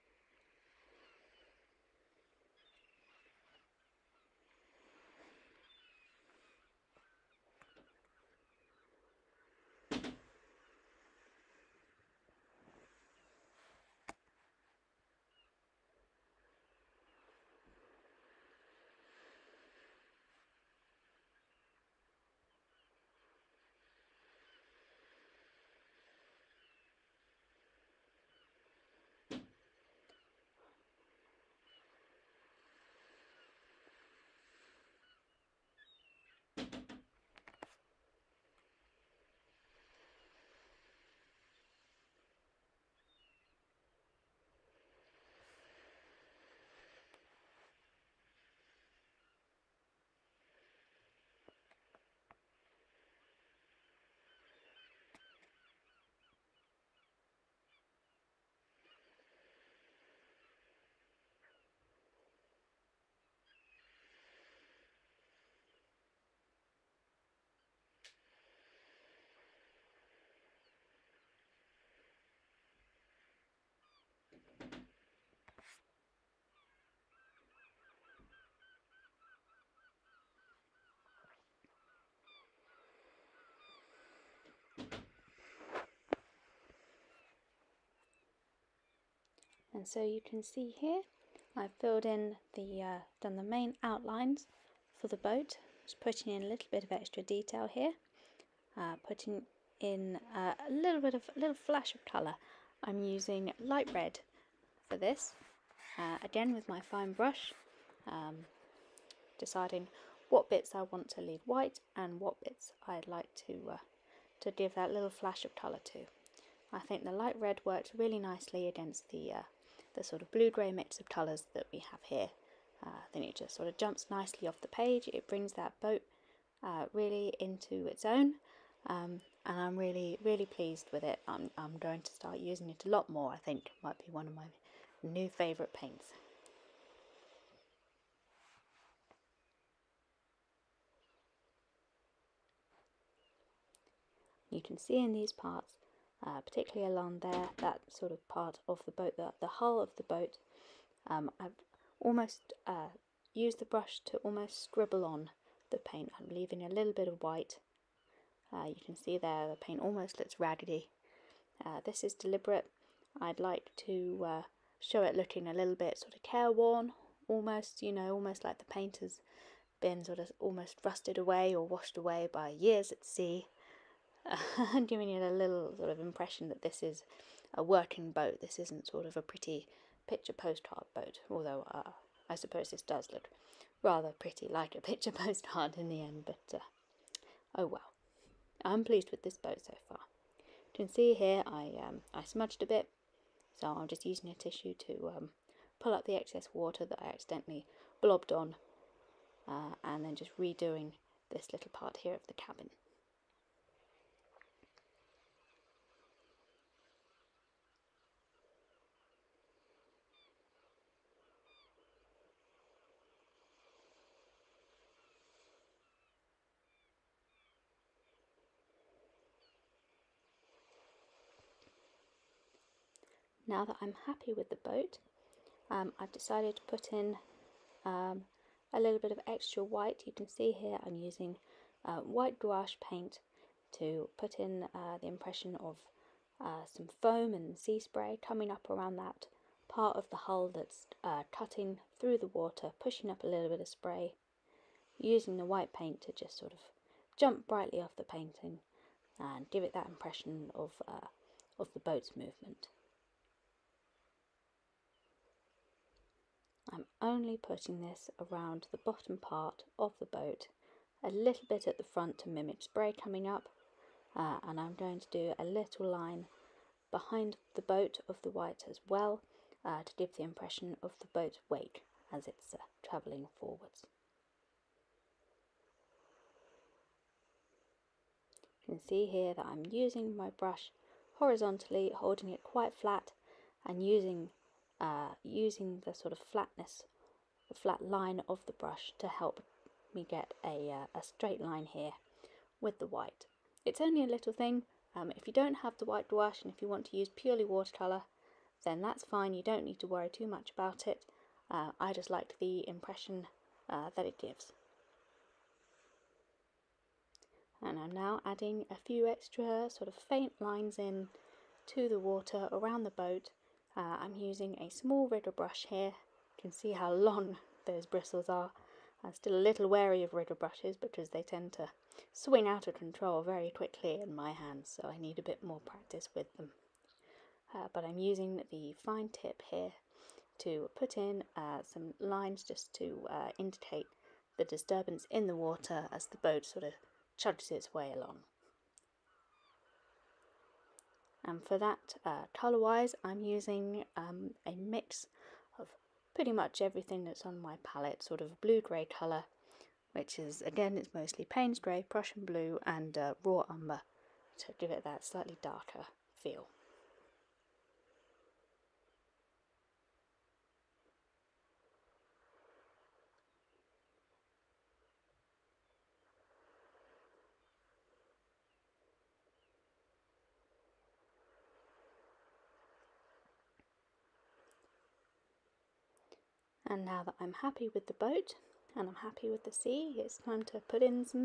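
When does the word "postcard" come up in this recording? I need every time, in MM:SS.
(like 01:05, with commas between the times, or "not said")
03:00, 03:05.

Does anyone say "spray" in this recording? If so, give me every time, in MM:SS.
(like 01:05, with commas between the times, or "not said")
03:57, 04:03, 04:22.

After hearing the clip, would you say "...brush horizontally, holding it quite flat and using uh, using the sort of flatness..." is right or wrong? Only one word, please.
right.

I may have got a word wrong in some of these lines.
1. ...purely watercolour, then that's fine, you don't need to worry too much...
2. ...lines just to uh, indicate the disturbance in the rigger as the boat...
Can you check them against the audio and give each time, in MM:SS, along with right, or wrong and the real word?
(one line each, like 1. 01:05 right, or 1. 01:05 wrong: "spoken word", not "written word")
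1. 04:57 right
2. 05:31 wrong: "water", not "rigger".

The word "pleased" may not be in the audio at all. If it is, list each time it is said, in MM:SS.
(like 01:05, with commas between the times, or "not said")
02:10, 03:08.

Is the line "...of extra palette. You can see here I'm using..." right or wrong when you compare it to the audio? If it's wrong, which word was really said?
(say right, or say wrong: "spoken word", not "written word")
wrong: "white", not "palette".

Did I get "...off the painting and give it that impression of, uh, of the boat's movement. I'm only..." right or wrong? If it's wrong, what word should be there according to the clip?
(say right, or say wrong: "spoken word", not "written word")
right.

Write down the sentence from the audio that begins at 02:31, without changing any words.
Um, I've almost uh, used the brush to almost scribble on the paint.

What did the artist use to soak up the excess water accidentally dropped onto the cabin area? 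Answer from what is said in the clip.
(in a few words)
A tissue.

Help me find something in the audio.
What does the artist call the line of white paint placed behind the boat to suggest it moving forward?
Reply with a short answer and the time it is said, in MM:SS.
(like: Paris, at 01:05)
The boat's wake, at 04:31.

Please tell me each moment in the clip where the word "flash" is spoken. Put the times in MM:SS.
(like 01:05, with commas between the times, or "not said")
01:41, 01:55.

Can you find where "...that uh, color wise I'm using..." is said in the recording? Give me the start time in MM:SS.
05:41.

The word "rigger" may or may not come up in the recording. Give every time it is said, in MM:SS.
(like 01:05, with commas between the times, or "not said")
05:15, 05:20.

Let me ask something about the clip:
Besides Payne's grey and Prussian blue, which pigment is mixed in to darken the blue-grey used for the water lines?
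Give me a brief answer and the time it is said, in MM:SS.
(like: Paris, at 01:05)
Raw umber, at 05:53.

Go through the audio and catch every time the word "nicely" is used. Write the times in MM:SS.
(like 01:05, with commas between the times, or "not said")
01:58, 02:04.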